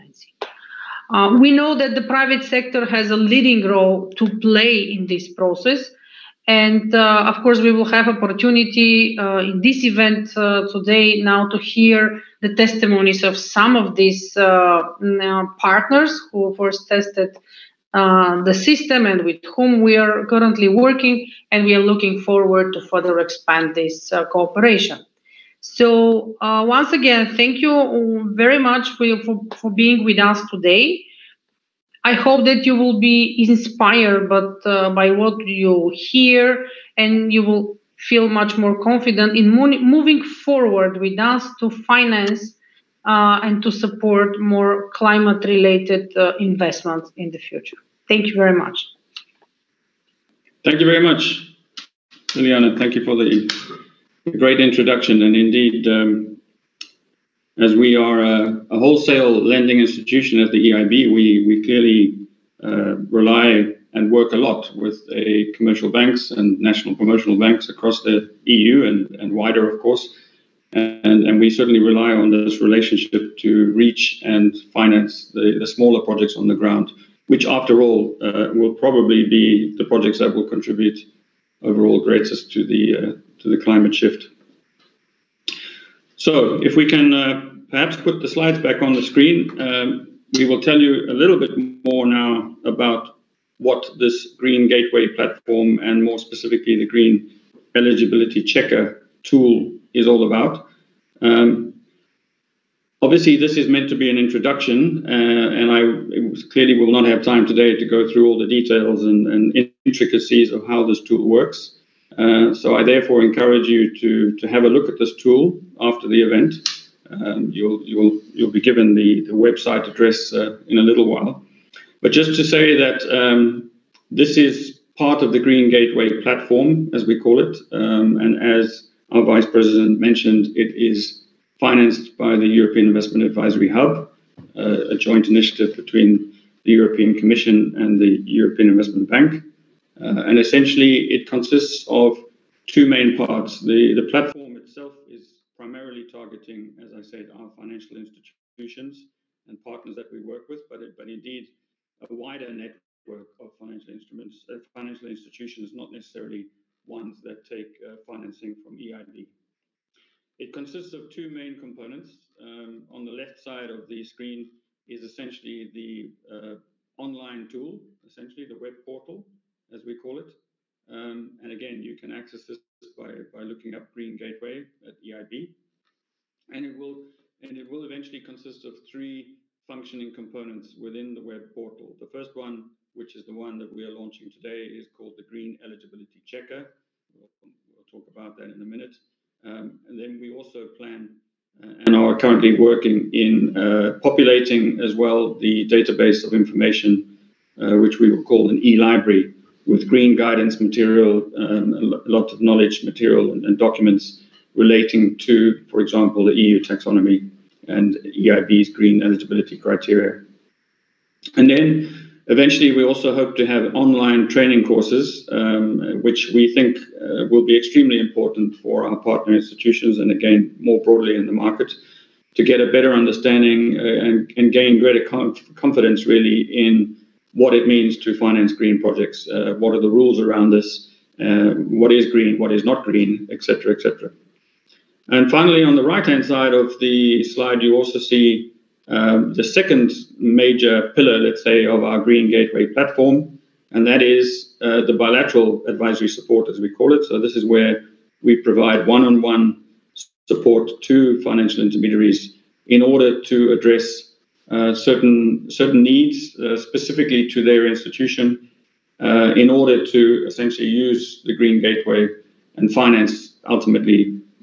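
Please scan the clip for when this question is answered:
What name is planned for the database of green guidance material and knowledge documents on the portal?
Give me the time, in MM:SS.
03:18.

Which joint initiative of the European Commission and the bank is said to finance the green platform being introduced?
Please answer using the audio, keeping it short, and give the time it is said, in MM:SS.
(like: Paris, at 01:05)
European Investment Advisory Hub, at 02:12.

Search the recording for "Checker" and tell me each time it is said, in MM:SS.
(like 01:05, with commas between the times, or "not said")
01:38, 03:06.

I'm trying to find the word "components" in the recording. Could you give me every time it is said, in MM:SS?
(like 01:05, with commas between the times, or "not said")
02:41, 03:00.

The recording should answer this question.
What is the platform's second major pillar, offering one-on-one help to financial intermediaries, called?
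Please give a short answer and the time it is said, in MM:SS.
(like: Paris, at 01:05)
bilateral advisory support, at 04:04.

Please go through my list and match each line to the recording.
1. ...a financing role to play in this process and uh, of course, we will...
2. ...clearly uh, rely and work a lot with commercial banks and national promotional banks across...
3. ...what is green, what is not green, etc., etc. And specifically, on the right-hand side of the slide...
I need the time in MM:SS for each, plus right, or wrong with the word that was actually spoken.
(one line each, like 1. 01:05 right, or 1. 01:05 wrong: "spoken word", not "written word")
1. 00:03 wrong: "leading", not "financing"
2. 01:01 right
3. 03:51 wrong: "finally", not "specifically".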